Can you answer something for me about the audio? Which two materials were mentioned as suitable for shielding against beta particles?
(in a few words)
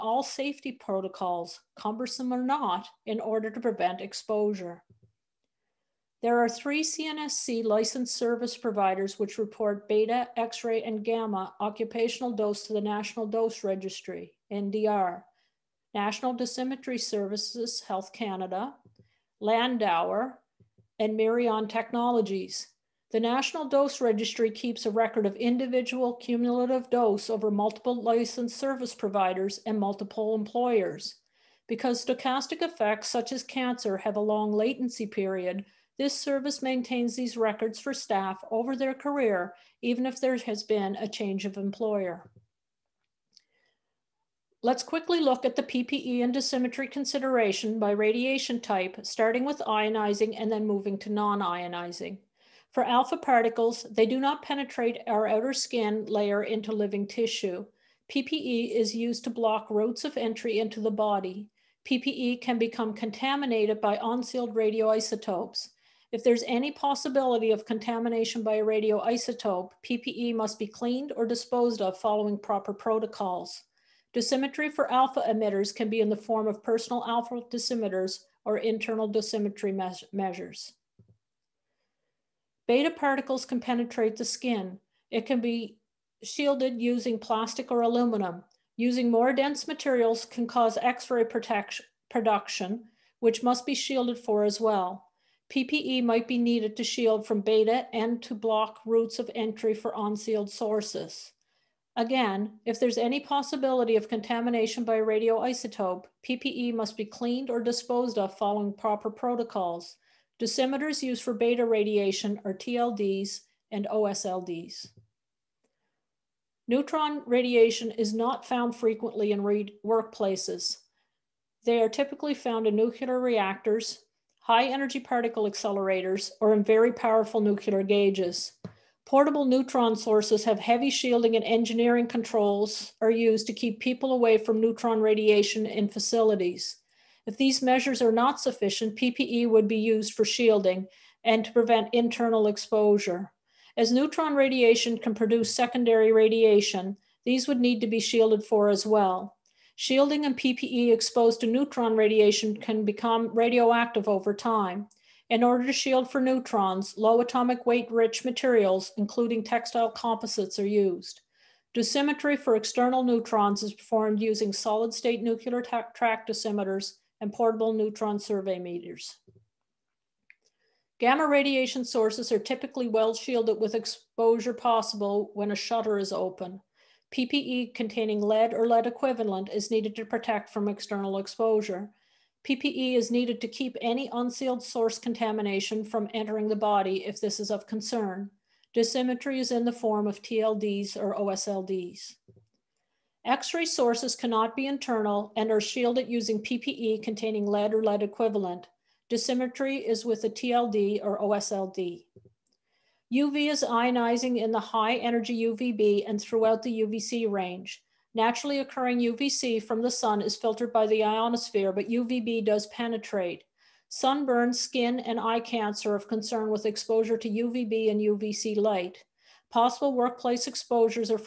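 Plastic or aluminum.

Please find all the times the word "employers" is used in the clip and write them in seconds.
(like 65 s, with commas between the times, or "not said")
30 s, 41 s.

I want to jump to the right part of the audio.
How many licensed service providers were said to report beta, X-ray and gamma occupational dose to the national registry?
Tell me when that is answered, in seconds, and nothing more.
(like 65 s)
6 s.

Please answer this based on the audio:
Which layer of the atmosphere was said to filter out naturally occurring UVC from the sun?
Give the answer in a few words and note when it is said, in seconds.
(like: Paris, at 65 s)
Ionosphere, at 211 s.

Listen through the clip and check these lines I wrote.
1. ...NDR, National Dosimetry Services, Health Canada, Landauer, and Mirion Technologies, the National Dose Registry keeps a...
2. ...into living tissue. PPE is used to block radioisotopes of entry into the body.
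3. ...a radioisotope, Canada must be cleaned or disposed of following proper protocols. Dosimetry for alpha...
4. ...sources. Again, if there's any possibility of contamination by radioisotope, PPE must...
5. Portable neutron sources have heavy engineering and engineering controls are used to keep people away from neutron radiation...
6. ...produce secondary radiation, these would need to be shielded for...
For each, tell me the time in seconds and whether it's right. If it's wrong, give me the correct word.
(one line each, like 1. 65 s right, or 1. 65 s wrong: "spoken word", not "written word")
1. 14 s right
2. 56 s wrong: "routes", not "radioisotopes"
3. 68 s wrong: "PPE", not "Canada"
4. 100 s right
5. 129 s wrong: "shielding", not "engineering"
6. 145 s right.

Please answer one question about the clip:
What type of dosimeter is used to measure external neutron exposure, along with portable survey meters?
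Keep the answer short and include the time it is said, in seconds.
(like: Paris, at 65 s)
Solid state nuclear track dosimeters, at 164 s.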